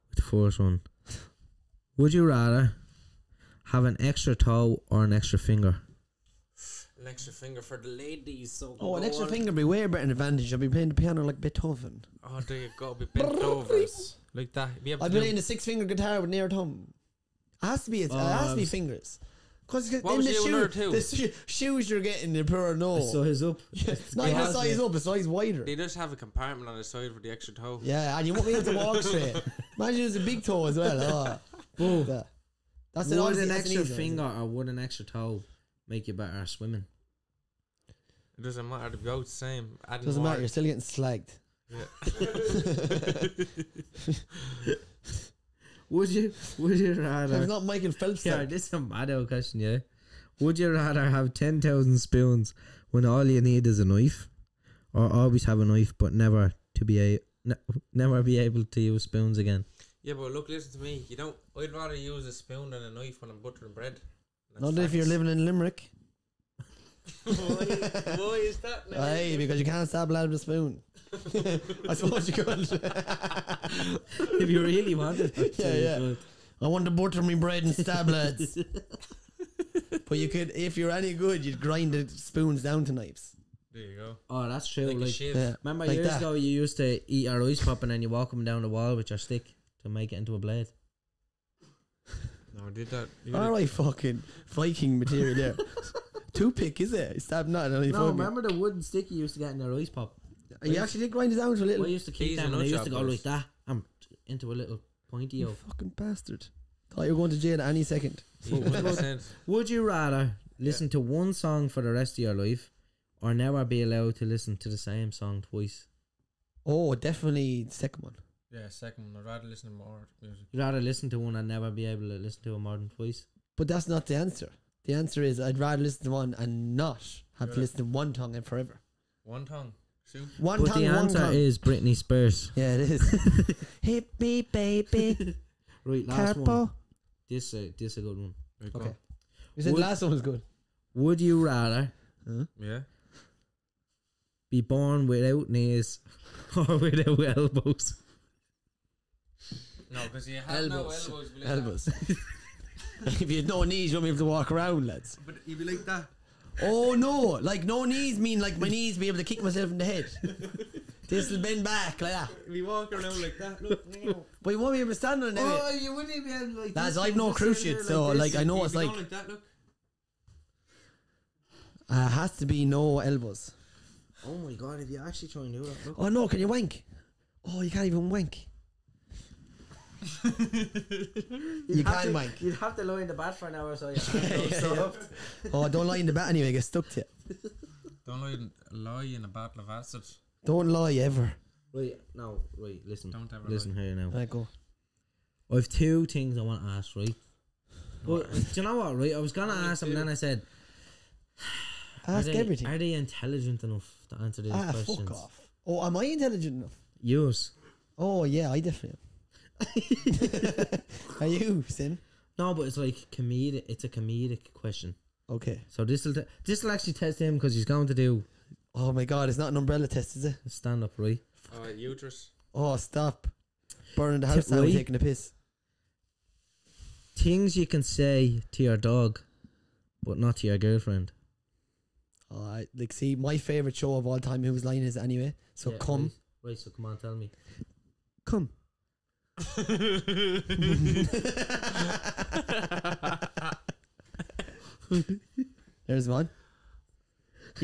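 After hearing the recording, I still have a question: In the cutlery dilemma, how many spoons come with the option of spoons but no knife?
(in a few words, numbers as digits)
10000.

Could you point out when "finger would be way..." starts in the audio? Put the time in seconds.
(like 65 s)
9 s.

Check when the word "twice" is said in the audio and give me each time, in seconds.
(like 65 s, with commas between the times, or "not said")
115 s, 122 s.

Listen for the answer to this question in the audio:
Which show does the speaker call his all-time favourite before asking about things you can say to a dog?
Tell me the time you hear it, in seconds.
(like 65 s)
234 s.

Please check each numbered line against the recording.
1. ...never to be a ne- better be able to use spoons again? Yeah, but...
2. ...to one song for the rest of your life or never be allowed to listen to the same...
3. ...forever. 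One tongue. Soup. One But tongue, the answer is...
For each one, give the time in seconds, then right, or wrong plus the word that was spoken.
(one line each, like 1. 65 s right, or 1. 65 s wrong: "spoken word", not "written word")
1. 56 s wrong: "never", not "better"
2. 110 s right
3. 128 s right.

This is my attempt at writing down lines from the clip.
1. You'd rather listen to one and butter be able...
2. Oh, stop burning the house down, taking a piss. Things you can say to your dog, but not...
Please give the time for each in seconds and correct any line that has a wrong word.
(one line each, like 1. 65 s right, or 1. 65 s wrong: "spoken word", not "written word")
1. 120 s wrong: "never", not "butter"
2. 222 s right.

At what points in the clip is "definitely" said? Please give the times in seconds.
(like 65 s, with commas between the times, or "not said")
116 s, 208 s.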